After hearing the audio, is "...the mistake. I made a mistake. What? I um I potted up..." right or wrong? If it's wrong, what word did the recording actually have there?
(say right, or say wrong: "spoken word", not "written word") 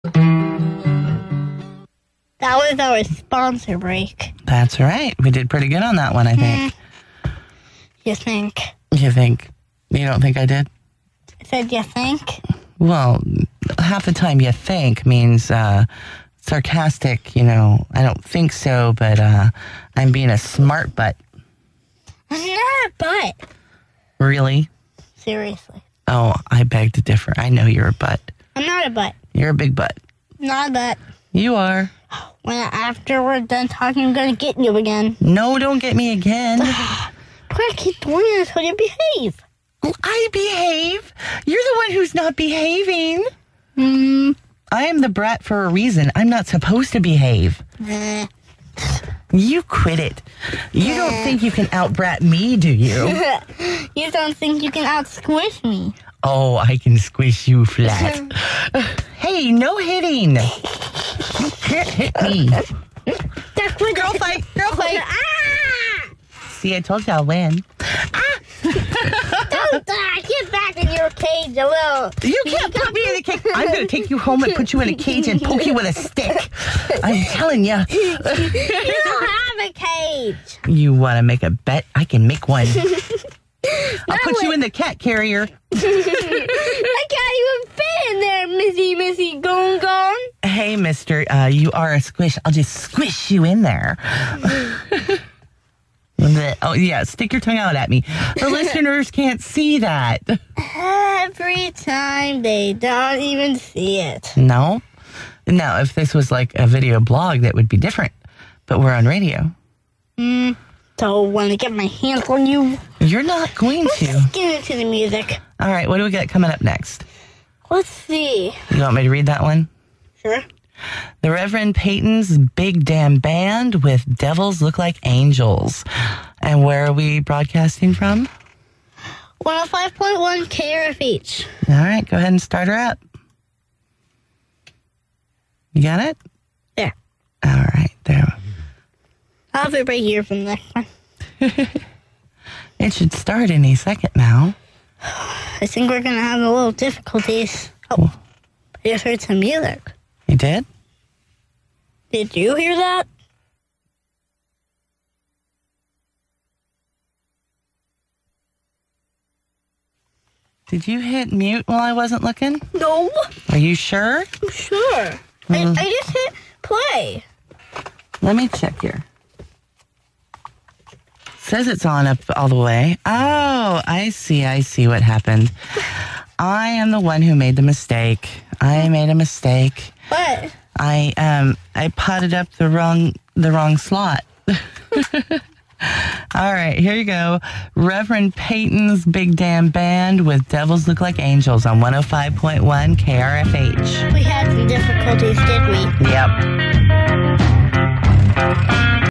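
right.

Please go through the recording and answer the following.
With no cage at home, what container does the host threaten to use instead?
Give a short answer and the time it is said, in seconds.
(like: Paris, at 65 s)
cat carrier, at 84 s.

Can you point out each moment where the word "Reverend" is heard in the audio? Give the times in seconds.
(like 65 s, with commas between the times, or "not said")
121 s, 187 s.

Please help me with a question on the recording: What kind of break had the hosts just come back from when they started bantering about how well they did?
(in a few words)
sponsor break.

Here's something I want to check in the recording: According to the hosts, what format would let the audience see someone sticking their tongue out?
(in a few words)
video blog.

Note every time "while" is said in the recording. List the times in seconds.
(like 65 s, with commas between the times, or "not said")
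161 s.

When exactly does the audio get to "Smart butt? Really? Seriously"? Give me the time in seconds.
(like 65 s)
22 s.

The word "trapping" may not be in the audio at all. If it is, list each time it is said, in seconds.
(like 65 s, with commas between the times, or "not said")
not said.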